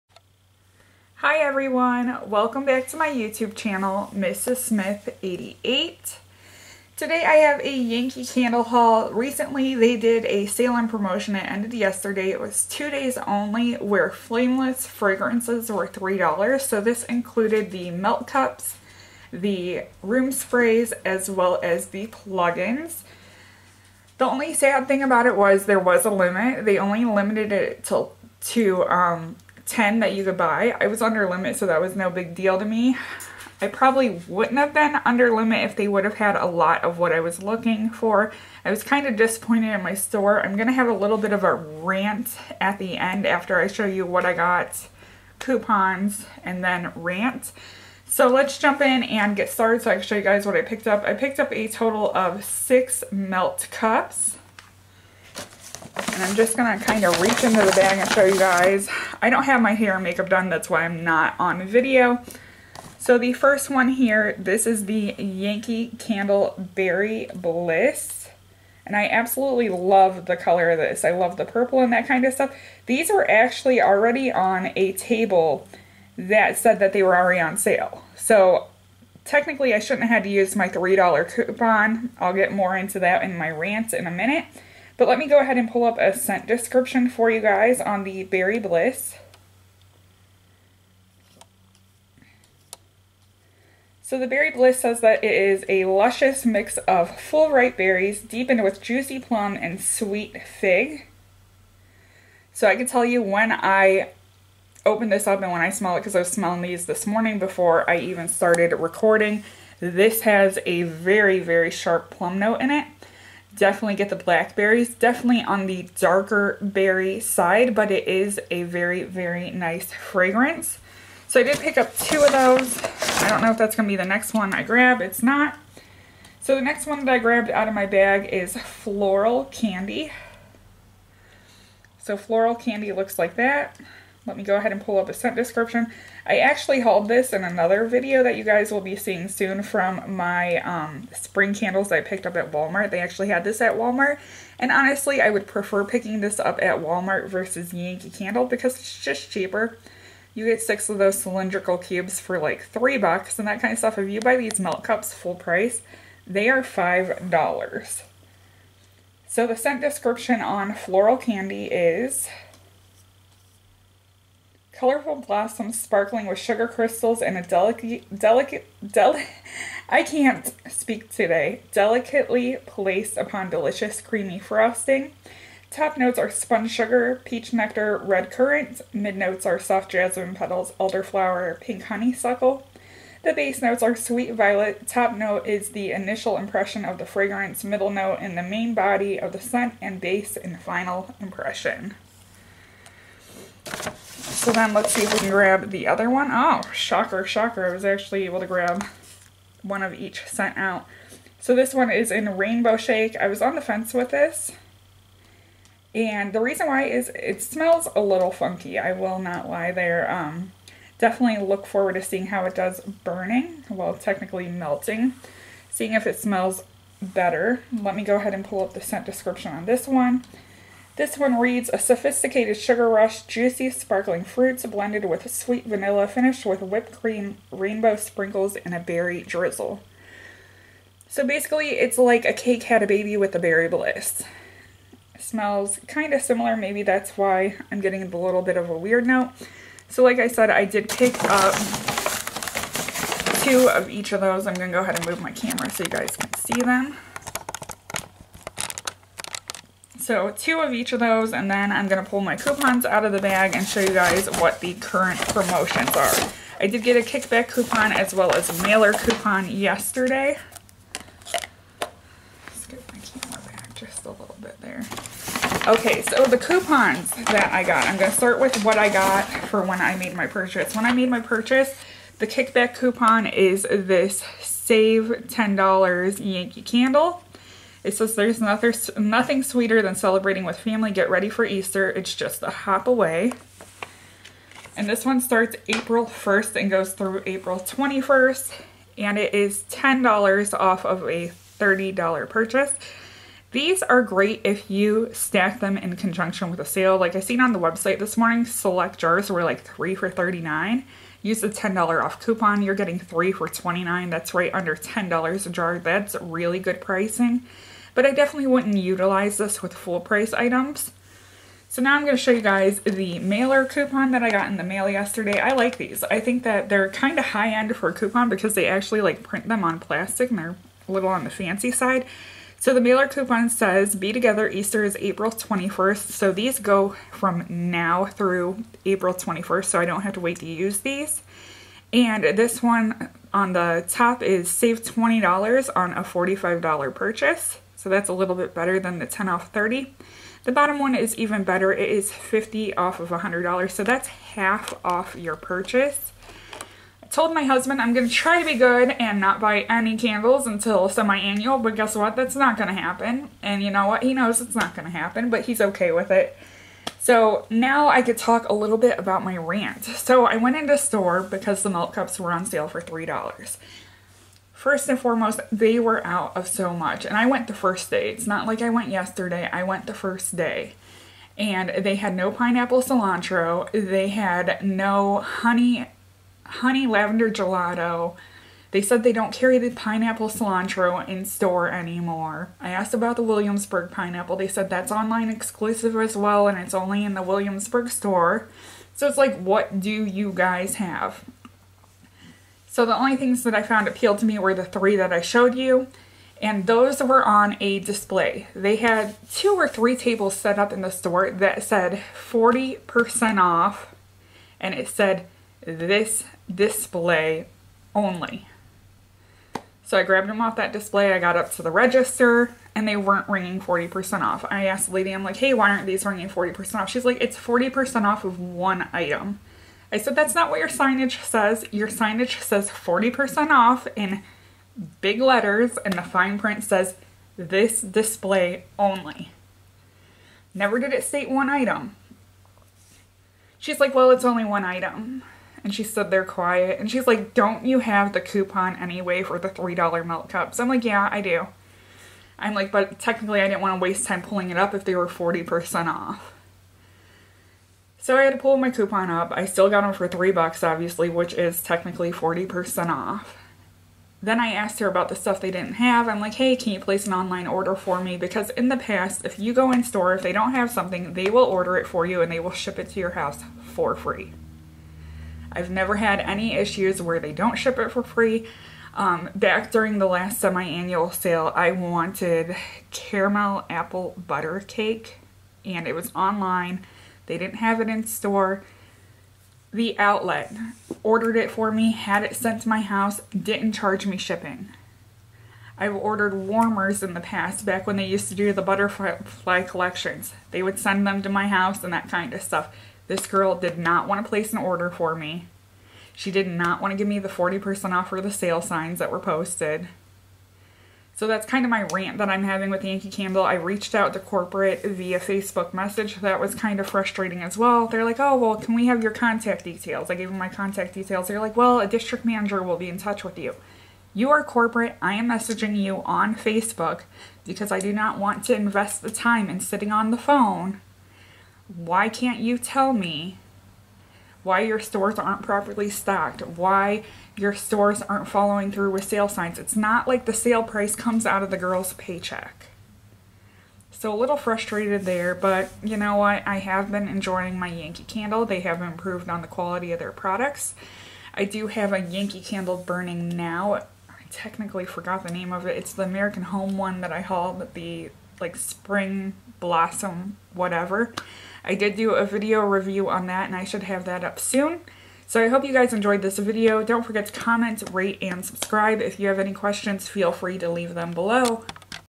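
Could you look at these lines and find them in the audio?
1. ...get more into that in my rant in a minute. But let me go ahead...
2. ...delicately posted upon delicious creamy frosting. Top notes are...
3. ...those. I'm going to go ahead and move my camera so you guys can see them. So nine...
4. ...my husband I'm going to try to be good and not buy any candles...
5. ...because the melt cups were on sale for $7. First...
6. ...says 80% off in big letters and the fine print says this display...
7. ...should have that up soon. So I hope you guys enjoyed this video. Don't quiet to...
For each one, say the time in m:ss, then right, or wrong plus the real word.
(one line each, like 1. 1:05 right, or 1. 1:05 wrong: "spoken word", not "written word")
1. 1:22 right
2. 2:51 wrong: "placed", not "posted"
3. 4:04 wrong: "two", not "nine"
4. 5:47 right
5. 6:01 wrong: "3", not "7"
6. 7:02 wrong: "40", not "80"
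7. 9:13 wrong: "forget", not "quiet".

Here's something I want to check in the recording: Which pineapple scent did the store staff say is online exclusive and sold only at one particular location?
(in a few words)
Williamsburg pineapple.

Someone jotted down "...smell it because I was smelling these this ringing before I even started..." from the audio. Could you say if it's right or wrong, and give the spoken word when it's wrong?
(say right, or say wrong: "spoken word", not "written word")
wrong: "morning", not "ringing".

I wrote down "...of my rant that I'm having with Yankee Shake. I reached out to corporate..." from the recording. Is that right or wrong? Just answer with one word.
wrong.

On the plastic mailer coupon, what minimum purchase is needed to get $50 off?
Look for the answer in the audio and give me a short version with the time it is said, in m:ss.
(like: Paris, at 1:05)
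$100, at 5:43.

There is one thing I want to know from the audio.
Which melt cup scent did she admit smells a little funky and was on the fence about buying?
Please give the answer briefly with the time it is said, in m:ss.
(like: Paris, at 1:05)
Rainbow Shake, at 3:22.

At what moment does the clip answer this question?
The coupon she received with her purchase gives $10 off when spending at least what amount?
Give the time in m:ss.
4:51.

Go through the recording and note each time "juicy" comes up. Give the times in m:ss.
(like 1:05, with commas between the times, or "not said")
1:38, 3:43.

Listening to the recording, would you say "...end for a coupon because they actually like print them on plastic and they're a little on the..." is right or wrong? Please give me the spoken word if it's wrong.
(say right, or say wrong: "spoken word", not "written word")
right.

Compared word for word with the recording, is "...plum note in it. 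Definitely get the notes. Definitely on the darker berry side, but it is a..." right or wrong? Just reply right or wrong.
wrong.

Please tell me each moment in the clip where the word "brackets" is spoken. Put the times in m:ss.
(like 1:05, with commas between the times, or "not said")
not said.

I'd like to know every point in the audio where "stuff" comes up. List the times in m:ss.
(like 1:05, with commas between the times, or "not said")
1:12, 2:33, 7:35, 8:12.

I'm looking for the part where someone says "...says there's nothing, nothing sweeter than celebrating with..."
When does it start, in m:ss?
4:37.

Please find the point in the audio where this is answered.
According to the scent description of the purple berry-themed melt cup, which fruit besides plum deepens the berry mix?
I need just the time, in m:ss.
1:39.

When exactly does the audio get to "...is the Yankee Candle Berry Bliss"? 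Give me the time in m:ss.
1:04.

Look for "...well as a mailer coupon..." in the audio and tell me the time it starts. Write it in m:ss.
4:18.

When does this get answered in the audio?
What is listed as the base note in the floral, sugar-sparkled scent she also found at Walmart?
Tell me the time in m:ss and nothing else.
3:03.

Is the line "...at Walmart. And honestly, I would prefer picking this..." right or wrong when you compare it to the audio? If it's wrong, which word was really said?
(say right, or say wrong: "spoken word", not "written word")
right.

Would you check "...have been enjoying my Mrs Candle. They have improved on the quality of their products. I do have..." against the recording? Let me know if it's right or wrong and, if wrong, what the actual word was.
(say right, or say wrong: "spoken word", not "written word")
wrong: "Yankee", not "Mrs".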